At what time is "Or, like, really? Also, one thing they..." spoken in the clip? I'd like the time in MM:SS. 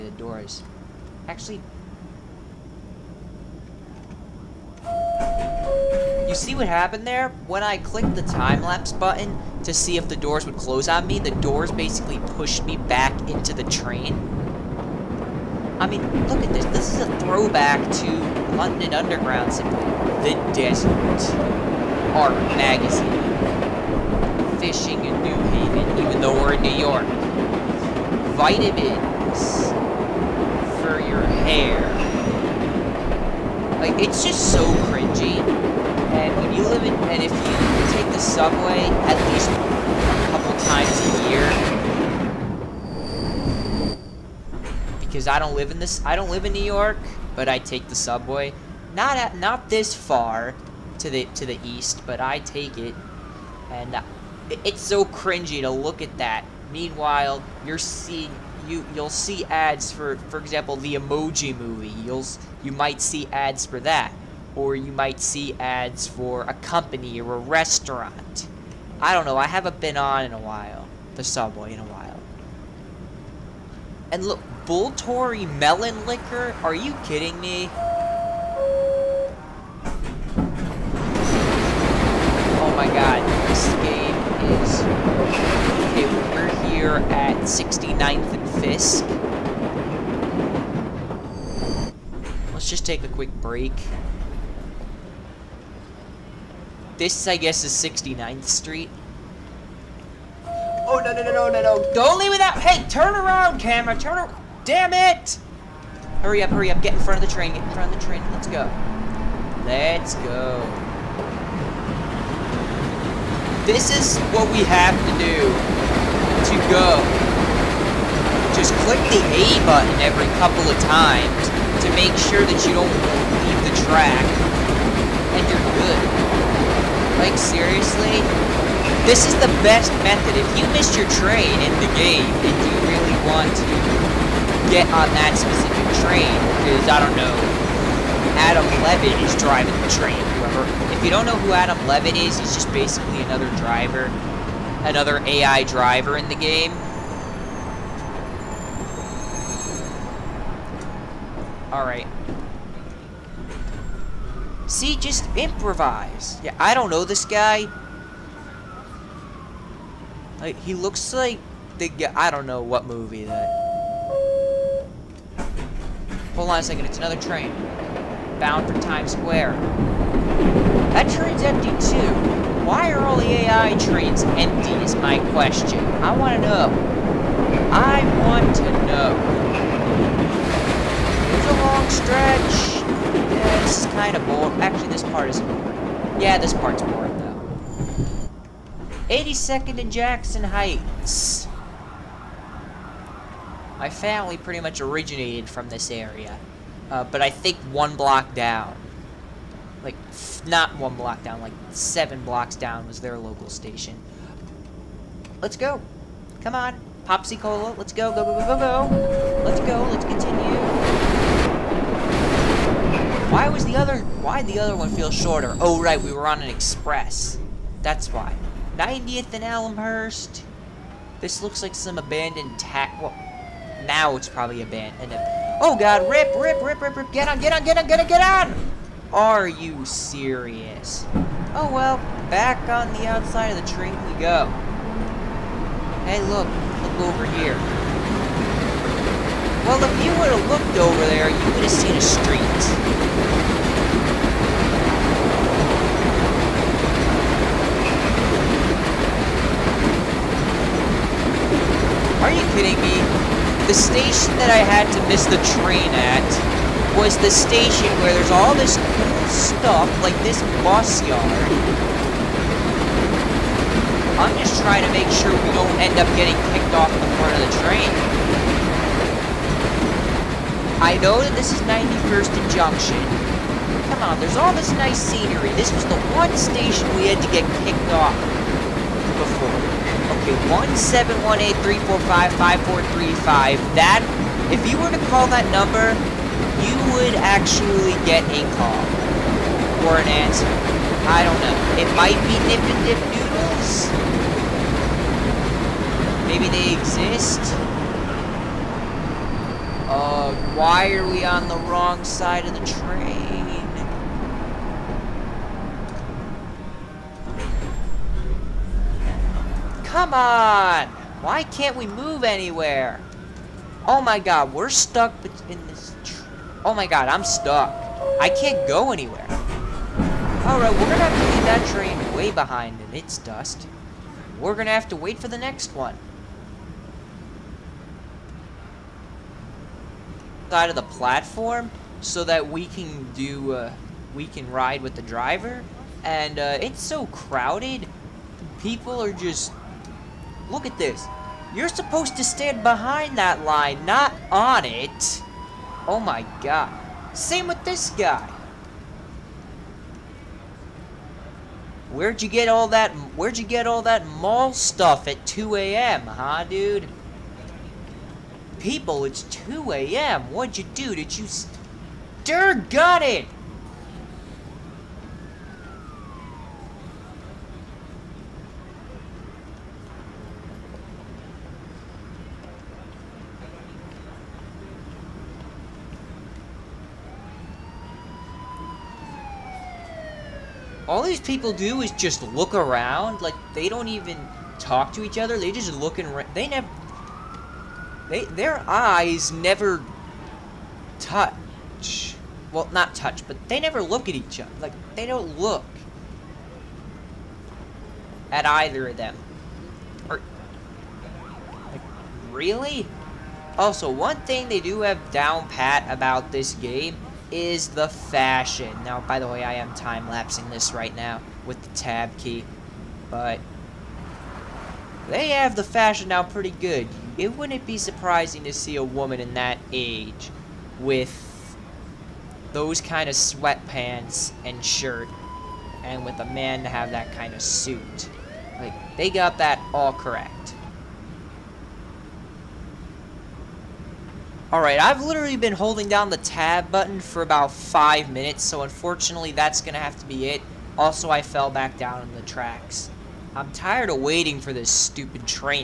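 06:40.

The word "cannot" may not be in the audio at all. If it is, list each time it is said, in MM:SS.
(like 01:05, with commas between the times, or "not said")
not said.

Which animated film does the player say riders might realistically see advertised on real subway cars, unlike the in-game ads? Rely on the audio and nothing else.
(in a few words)
The Emoji Movie.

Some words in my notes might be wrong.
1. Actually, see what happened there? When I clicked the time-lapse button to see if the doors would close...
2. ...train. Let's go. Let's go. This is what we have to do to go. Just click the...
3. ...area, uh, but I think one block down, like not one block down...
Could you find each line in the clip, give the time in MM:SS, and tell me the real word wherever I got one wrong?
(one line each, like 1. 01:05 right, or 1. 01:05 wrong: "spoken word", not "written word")
1. 00:01 right
2. 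01:48 right
3. 03:15 right.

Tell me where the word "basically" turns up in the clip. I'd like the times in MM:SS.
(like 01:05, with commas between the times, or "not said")
00:11, 02:22.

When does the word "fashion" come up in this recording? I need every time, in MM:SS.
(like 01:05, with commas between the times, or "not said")
06:47, 06:55.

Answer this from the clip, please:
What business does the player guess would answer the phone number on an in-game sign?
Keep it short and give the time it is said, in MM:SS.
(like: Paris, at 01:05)
Nip and Dip Noodles, at 04:52.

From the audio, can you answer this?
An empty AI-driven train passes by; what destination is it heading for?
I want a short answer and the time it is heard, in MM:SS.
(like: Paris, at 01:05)
Times Square, at 02:48.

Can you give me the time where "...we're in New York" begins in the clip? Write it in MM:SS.
00:26.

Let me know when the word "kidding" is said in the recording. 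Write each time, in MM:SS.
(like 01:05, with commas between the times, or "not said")
01:17, 04:12.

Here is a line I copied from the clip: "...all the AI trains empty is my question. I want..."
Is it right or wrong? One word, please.
right.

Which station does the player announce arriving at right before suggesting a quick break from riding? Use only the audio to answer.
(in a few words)
69th and Fisk.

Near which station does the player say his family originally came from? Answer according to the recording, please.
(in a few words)
82nd and Jackson Heights.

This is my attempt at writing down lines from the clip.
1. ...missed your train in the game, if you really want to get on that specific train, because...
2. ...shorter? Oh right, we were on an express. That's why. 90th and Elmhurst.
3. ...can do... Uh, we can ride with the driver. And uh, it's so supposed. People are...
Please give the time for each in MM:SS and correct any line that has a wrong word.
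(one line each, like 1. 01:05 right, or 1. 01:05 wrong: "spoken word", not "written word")
1. 02:10 right
2. 03:35 right
3. 05:32 wrong: "crowded", not "supposed".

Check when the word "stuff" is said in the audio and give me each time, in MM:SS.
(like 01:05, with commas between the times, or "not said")
04:19, 05:54.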